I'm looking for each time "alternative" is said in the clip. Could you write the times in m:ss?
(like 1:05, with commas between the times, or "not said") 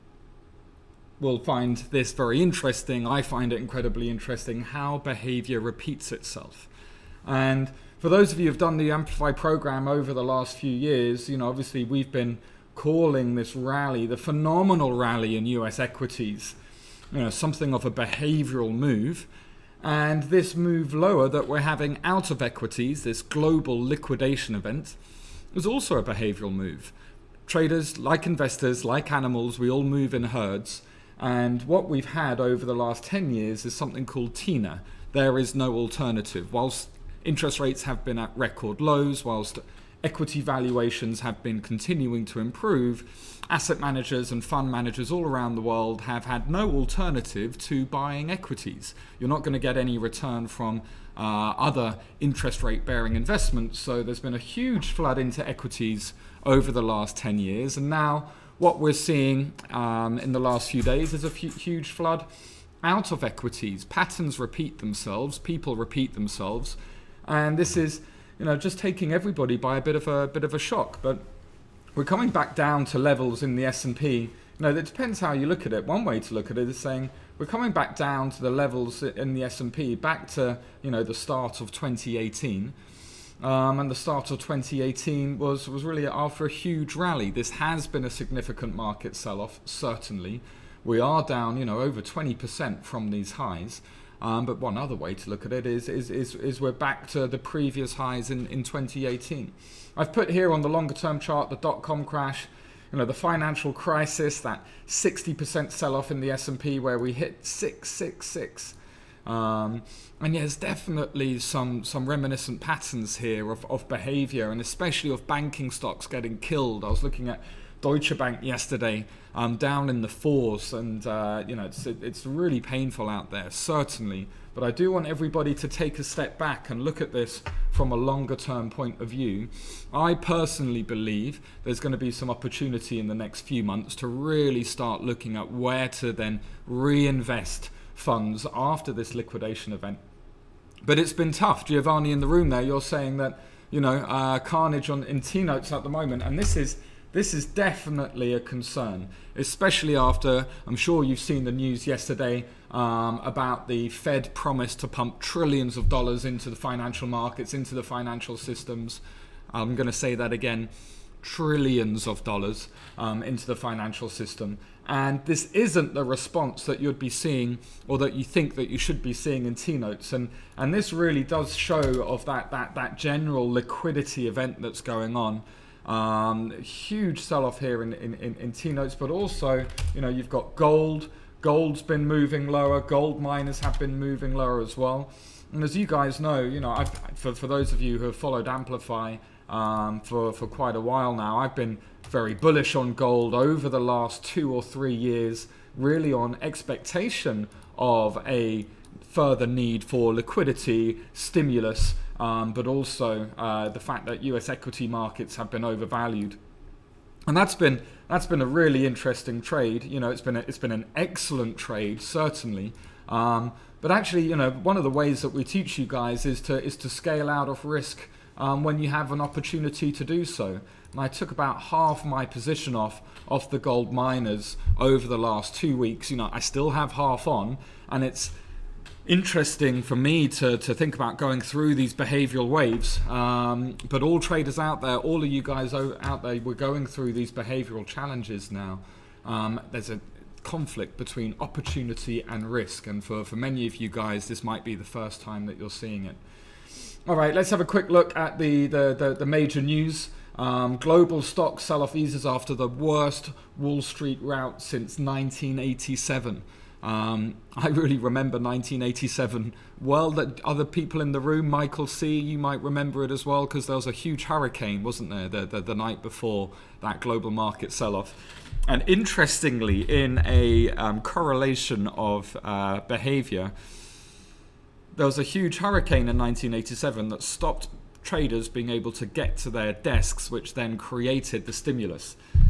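0:35, 0:46.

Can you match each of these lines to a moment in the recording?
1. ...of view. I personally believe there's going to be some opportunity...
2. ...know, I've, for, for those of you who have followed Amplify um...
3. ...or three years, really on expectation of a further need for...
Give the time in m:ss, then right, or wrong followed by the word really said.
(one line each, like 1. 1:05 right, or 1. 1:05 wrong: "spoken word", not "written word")
1. 2:09 right
2. 3:06 right
3. 3:14 right.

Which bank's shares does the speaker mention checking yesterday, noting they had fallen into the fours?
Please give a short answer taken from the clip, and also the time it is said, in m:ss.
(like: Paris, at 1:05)
Deutsche Bank, at 1:57.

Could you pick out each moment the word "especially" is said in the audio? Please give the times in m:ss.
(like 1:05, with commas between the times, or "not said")
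1:54, 2:29.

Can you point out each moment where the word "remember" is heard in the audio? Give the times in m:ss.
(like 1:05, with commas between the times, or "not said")
4:17, 4:22.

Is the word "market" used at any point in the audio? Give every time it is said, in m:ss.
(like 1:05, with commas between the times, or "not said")
1:28, 2:37, 3:24, 4:27.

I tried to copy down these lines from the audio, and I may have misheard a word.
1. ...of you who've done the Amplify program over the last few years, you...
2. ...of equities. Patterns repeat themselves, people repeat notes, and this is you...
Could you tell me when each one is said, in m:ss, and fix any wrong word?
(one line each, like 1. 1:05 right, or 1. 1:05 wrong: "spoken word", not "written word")
1. 0:08 right
2. 1:03 wrong: "themselves", not "notes".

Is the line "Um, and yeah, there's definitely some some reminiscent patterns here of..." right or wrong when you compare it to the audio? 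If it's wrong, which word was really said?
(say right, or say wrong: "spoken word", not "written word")
right.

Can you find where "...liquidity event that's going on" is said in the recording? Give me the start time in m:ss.
2:53.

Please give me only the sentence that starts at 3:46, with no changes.
You know, I still have half on, and it's interesting for me to, to think about going through these behavioral waves.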